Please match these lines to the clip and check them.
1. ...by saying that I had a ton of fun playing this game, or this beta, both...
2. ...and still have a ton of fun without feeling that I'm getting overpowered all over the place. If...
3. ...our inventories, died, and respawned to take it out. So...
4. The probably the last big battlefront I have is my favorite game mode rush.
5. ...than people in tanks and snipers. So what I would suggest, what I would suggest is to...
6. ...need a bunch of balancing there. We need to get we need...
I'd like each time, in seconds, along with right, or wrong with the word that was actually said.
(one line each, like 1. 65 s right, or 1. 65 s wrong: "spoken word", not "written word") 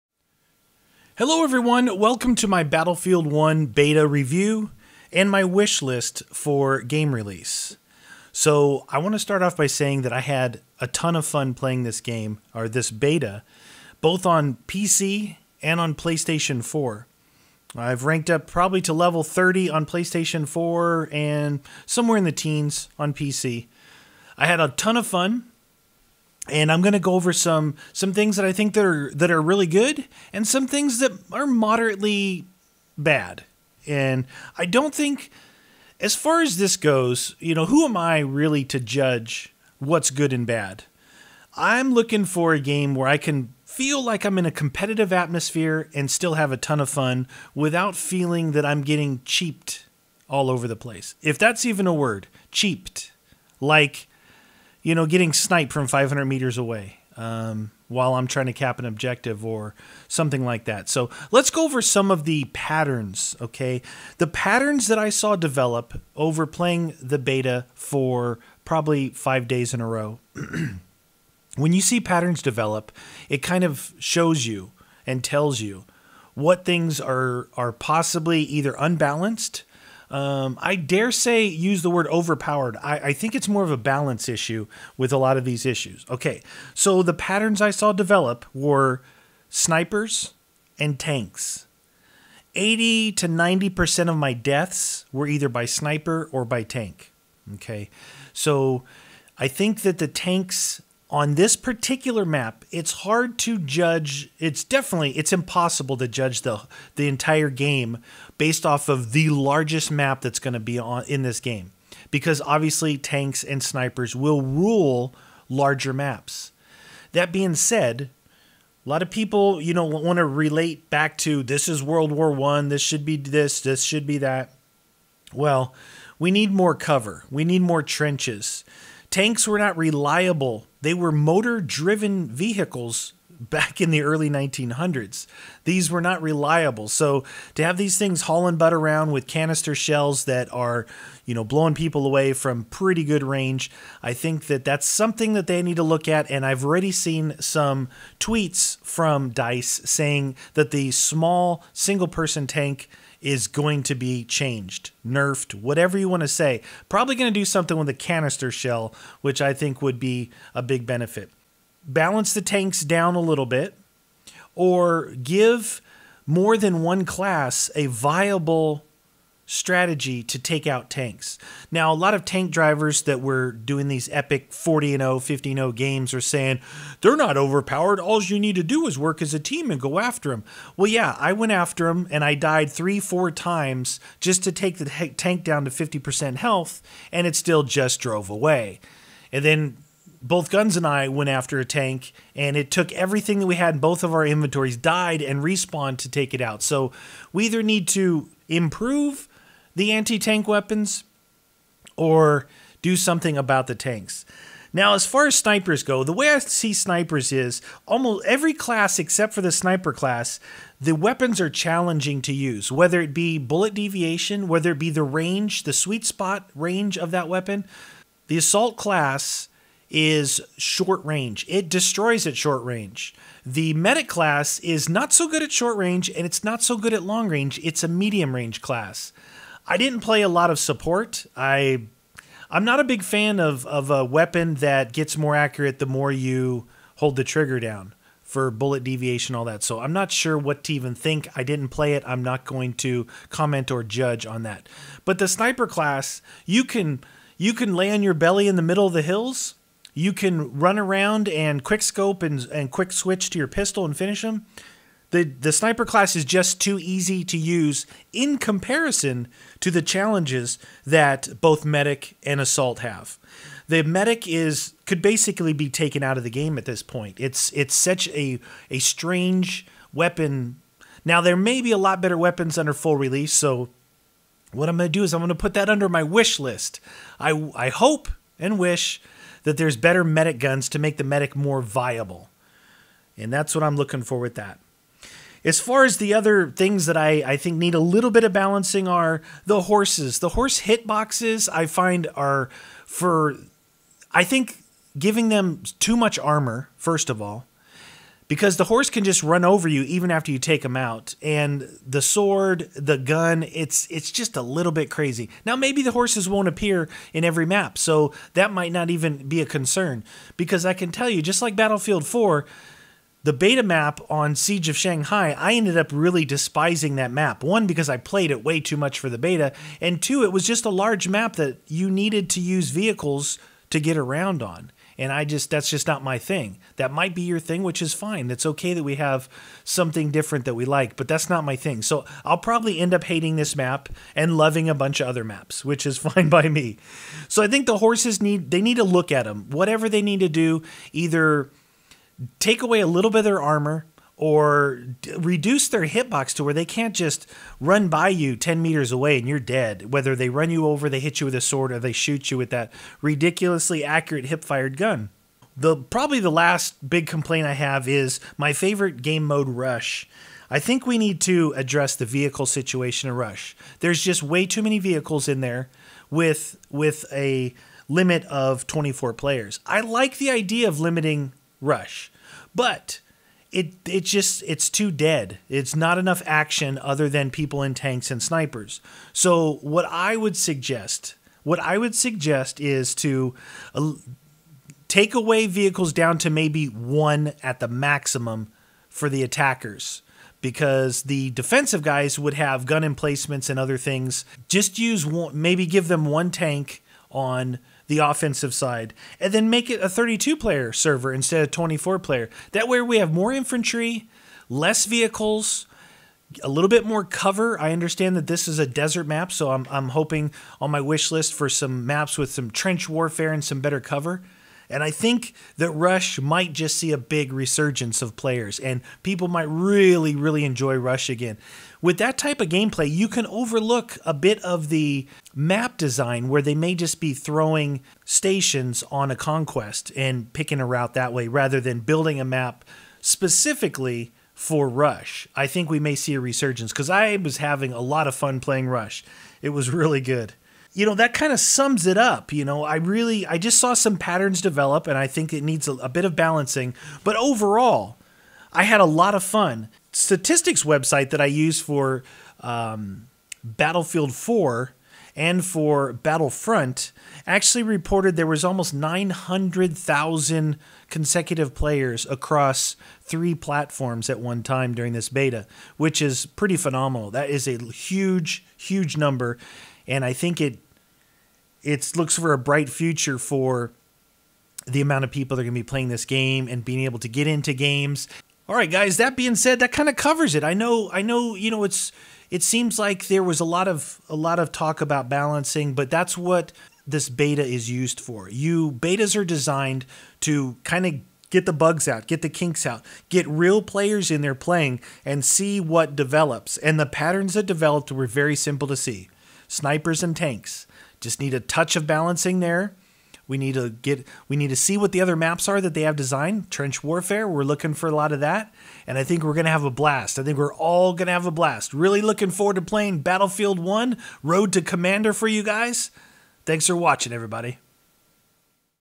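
1. 9 s right
2. 45 s wrong: "cheaped", not "overpowered"
3. 194 s right
4. 355 s wrong: "complaint", not "battlefront"
5. 377 s right
6. 501 s wrong: "touch", not "bunch".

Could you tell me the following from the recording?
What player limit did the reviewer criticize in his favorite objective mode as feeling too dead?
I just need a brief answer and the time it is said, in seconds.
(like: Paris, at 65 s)
24, at 368 s.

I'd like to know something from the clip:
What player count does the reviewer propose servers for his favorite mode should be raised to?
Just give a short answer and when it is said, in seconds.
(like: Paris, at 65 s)
32, at 399 s.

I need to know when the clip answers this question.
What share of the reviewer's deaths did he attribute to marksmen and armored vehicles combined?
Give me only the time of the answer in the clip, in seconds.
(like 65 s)
92 s.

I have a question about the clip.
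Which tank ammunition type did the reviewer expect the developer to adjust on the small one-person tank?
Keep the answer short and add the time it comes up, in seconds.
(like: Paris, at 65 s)
canister shell, at 157 s.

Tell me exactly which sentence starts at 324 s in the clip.
And I just, that's just not my thing.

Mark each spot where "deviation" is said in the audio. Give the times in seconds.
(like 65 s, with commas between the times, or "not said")
213 s, 238 s.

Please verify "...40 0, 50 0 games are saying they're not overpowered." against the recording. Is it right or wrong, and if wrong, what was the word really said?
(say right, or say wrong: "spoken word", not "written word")
right.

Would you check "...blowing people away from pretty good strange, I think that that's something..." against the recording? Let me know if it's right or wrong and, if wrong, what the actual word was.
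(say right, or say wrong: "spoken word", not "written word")
wrong: "range", not "strange".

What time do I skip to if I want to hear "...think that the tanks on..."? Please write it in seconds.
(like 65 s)
99 s.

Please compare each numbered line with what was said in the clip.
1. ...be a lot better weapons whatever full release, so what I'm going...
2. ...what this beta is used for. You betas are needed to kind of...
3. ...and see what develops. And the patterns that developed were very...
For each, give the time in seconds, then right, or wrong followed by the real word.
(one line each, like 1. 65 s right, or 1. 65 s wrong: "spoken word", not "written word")
1. 271 s wrong: "under", not "whatever"
2. 486 s wrong: "designed", not "needed"
3. 495 s right.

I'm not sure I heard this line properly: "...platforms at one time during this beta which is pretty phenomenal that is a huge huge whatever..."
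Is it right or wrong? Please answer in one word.
wrong.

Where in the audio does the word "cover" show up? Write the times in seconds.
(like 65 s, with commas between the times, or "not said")
126 s, 407 s, 413 s, 479 s.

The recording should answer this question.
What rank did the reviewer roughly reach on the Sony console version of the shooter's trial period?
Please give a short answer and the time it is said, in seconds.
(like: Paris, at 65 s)
level 30, at 18 s.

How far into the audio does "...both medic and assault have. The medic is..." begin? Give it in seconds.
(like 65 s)
261 s.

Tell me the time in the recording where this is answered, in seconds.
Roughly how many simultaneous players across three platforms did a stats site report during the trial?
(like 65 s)
458 s.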